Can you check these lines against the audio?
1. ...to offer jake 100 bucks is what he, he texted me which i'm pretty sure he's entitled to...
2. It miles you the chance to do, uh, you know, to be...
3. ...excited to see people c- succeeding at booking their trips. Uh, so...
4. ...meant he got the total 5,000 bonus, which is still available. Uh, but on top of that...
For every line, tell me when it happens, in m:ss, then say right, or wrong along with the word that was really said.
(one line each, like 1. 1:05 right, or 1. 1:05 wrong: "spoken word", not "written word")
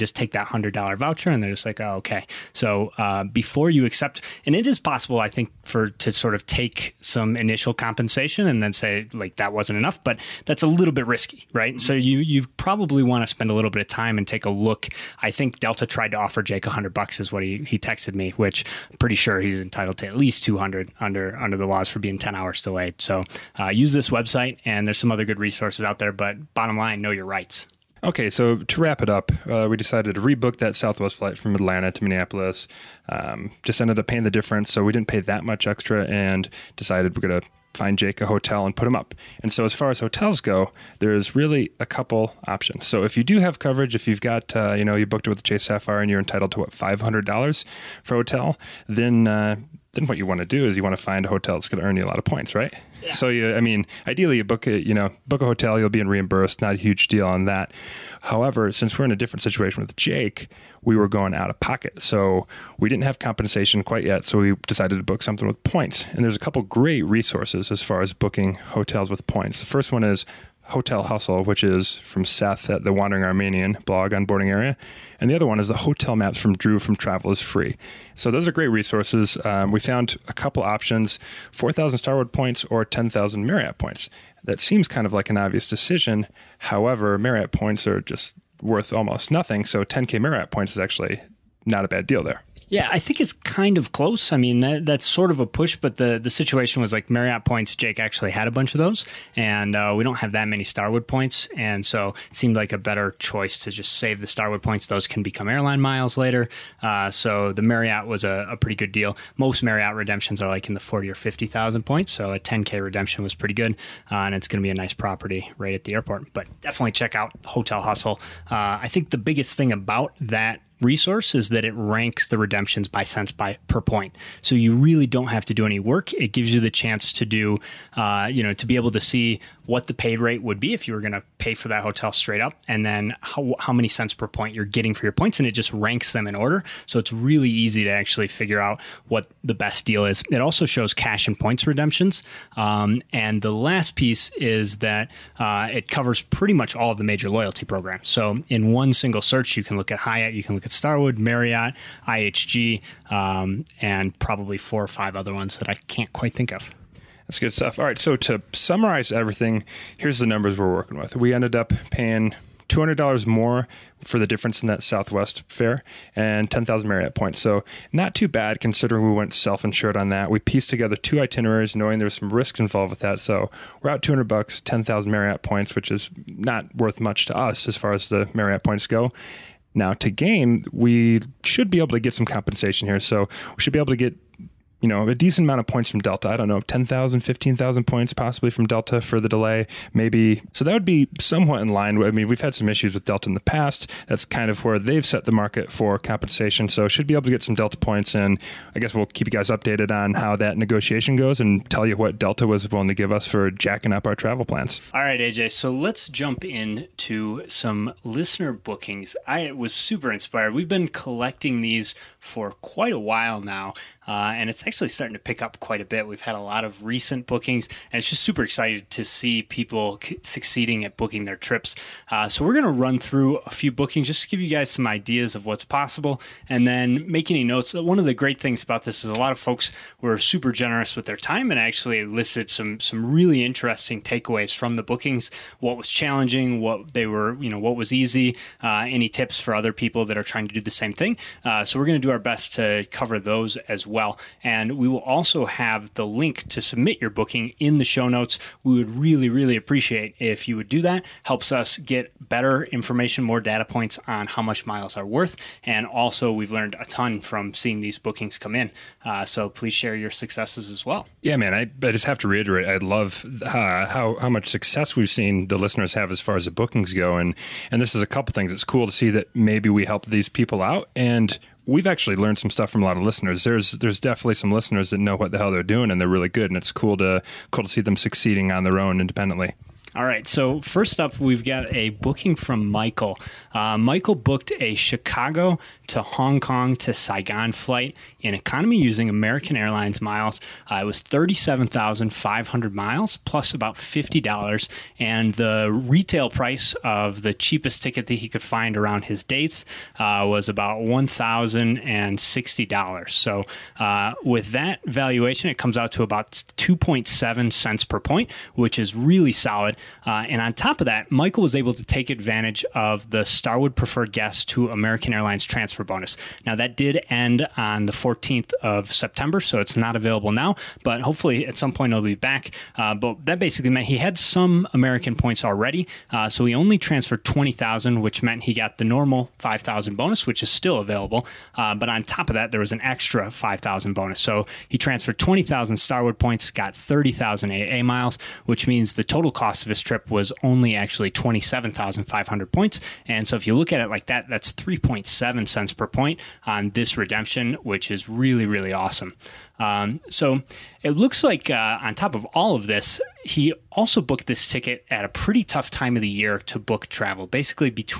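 1. 0:16 right
2. 2:06 wrong: "gives", not "miles"
3. 3:38 right
4. 5:28 wrong: "normal", not "total".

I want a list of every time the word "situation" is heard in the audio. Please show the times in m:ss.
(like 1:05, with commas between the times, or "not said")
0:59, 1:36.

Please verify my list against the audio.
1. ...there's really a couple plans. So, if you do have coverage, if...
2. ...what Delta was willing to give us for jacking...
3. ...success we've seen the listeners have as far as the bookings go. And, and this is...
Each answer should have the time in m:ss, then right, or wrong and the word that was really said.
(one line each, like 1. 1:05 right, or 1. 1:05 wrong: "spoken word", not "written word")
1. 0:40 wrong: "options", not "plans"
2. 3:21 right
3. 4:24 right.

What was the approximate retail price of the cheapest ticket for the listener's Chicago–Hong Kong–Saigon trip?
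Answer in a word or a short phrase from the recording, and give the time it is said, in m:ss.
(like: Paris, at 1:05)
$1,060, at 5:00.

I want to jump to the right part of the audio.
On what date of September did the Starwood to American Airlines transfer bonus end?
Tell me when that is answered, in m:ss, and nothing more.
5:17.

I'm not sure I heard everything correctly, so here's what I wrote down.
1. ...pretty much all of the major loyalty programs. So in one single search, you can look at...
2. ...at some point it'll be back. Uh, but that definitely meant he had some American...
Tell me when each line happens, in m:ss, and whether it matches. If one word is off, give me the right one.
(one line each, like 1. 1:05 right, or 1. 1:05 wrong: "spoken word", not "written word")
1. 2:26 right
2. 5:21 wrong: "basically", not "definitely".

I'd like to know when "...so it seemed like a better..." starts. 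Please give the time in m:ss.
1:41.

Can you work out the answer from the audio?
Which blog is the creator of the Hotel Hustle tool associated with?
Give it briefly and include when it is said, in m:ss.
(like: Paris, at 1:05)
The Wandering Aramean, at 1:12.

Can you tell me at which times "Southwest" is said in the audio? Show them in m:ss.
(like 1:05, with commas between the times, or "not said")
0:30, 2:44.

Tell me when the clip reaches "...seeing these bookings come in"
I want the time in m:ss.
4:17.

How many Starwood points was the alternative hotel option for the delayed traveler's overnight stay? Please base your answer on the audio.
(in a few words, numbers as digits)
4,000.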